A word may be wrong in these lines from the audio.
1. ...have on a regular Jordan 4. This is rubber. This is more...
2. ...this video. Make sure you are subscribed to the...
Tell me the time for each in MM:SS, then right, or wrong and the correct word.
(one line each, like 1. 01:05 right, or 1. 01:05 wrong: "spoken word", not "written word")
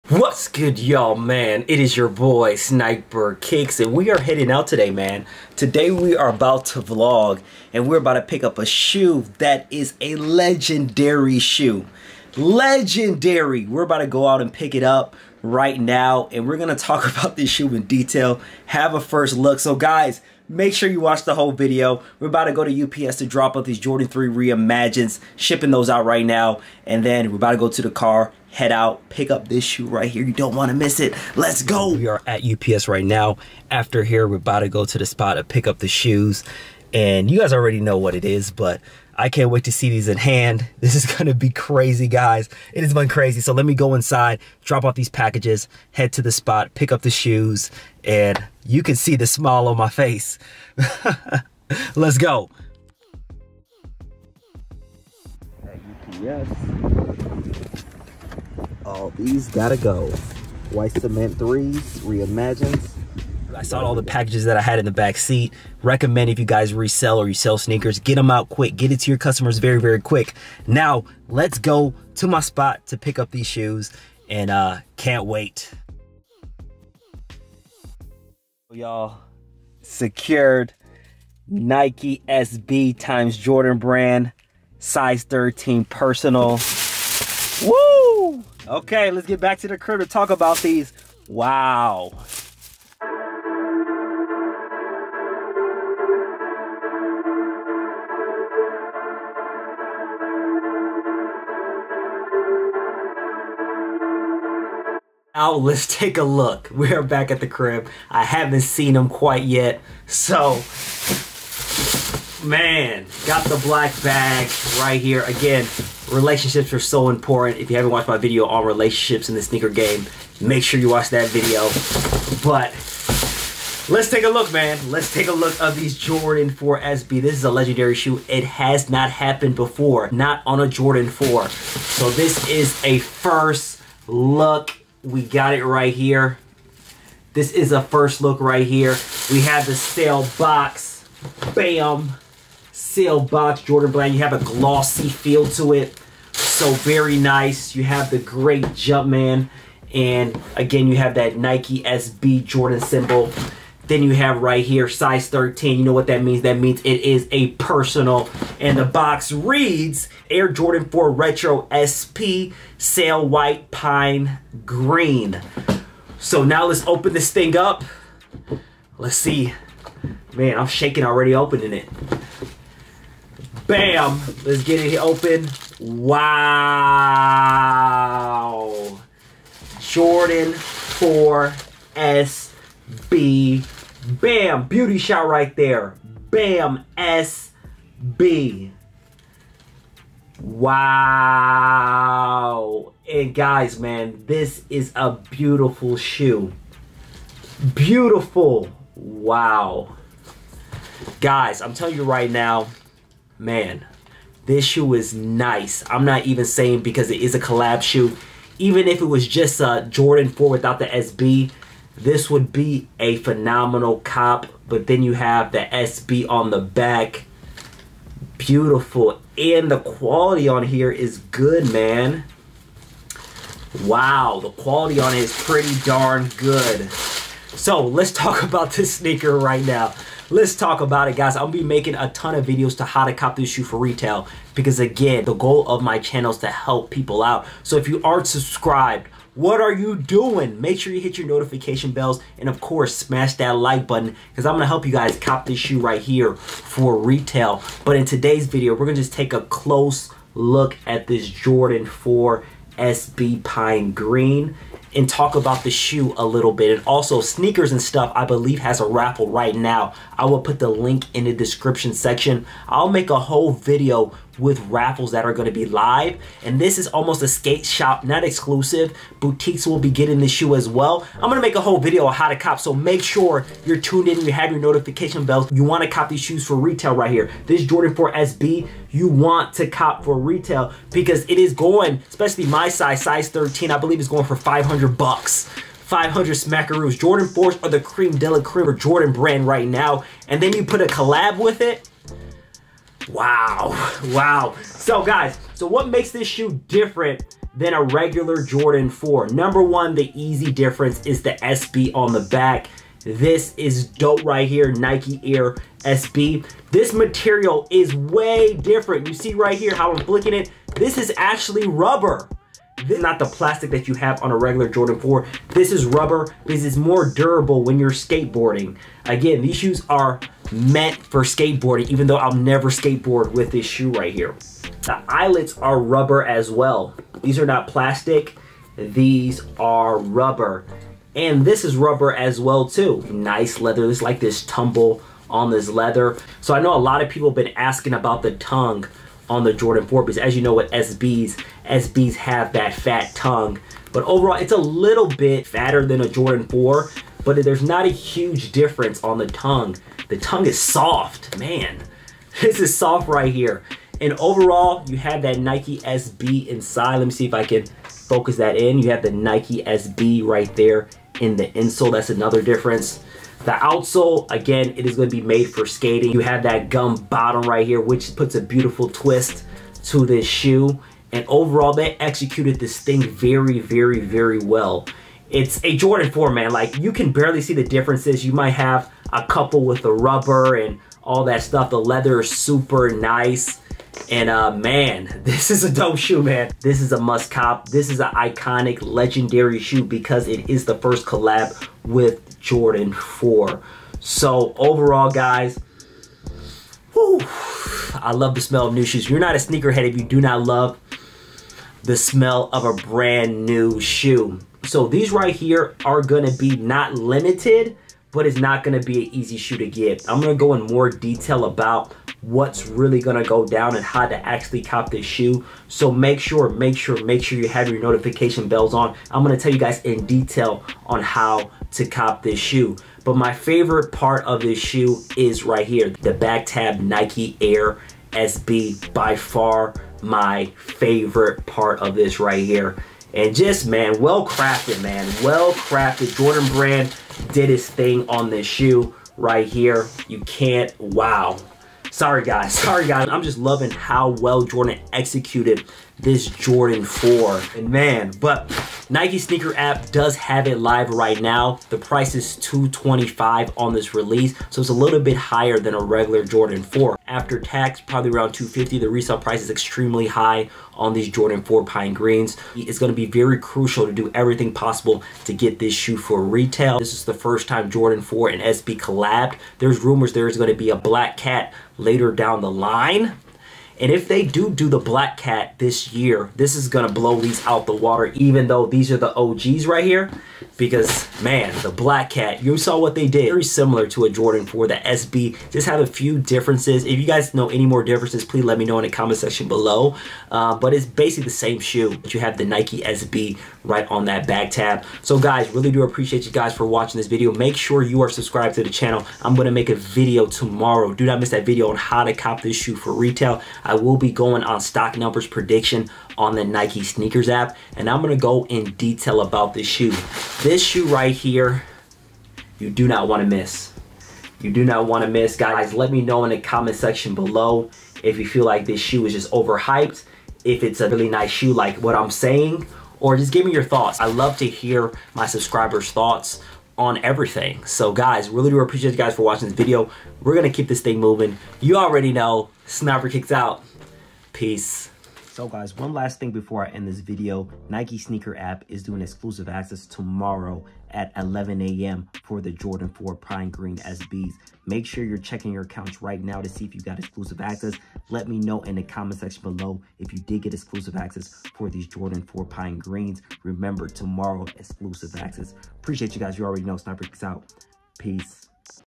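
1. 05:13 right
2. 08:16 right.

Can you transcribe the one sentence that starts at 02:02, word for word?
But let's take a look, man.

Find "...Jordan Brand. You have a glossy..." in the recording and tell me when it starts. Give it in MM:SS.
02:23.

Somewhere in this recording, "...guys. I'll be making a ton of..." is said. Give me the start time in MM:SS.
03:51.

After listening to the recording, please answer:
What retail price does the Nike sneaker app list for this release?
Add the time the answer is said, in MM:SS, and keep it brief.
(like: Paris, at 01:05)
$225, at 07:32.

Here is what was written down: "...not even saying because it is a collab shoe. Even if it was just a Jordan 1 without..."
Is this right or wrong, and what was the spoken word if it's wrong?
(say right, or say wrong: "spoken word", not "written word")
wrong: "4", not "1".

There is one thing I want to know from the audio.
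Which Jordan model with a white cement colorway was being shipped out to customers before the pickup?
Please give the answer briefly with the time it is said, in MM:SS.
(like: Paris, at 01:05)
Jordan 3 Reimagines, at 00:23.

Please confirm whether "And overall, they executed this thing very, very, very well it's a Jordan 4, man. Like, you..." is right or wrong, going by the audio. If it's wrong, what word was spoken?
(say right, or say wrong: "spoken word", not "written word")
right.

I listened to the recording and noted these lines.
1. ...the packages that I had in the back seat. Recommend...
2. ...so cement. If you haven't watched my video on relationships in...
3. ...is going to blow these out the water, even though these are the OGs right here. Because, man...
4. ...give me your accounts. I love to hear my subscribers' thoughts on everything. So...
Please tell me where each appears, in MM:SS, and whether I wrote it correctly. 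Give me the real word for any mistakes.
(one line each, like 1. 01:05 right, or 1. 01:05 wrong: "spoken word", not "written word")
1. 01:03 right
2. 01:56 wrong: "important", not "cement"
3. 07:56 right
4. 08:43 wrong: "thoughts", not "accounts".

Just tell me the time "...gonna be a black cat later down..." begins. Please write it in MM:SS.
07:50.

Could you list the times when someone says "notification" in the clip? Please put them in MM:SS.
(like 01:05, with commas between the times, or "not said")
04:01, 04:34, 06:57.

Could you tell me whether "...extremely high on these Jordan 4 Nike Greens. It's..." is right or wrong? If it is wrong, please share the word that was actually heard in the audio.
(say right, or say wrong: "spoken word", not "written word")
wrong: "Pine", not "Nike".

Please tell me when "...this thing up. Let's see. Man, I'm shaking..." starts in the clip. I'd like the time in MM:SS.
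02:47.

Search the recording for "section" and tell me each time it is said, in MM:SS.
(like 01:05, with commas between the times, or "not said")
04:21, 08:09, 08:36, 09:09.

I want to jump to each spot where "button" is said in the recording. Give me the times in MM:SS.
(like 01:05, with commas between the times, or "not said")
04:03.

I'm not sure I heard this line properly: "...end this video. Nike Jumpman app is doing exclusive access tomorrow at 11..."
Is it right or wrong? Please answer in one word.
wrong.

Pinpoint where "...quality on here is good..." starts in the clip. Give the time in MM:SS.
03:39.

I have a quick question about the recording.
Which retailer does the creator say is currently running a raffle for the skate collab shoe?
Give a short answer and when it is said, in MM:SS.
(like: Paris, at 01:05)
Sneakersnstuff, at 04:17.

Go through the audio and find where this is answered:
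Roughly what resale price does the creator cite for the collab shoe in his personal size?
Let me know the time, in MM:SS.
04:44.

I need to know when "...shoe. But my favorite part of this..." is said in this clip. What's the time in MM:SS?
07:02.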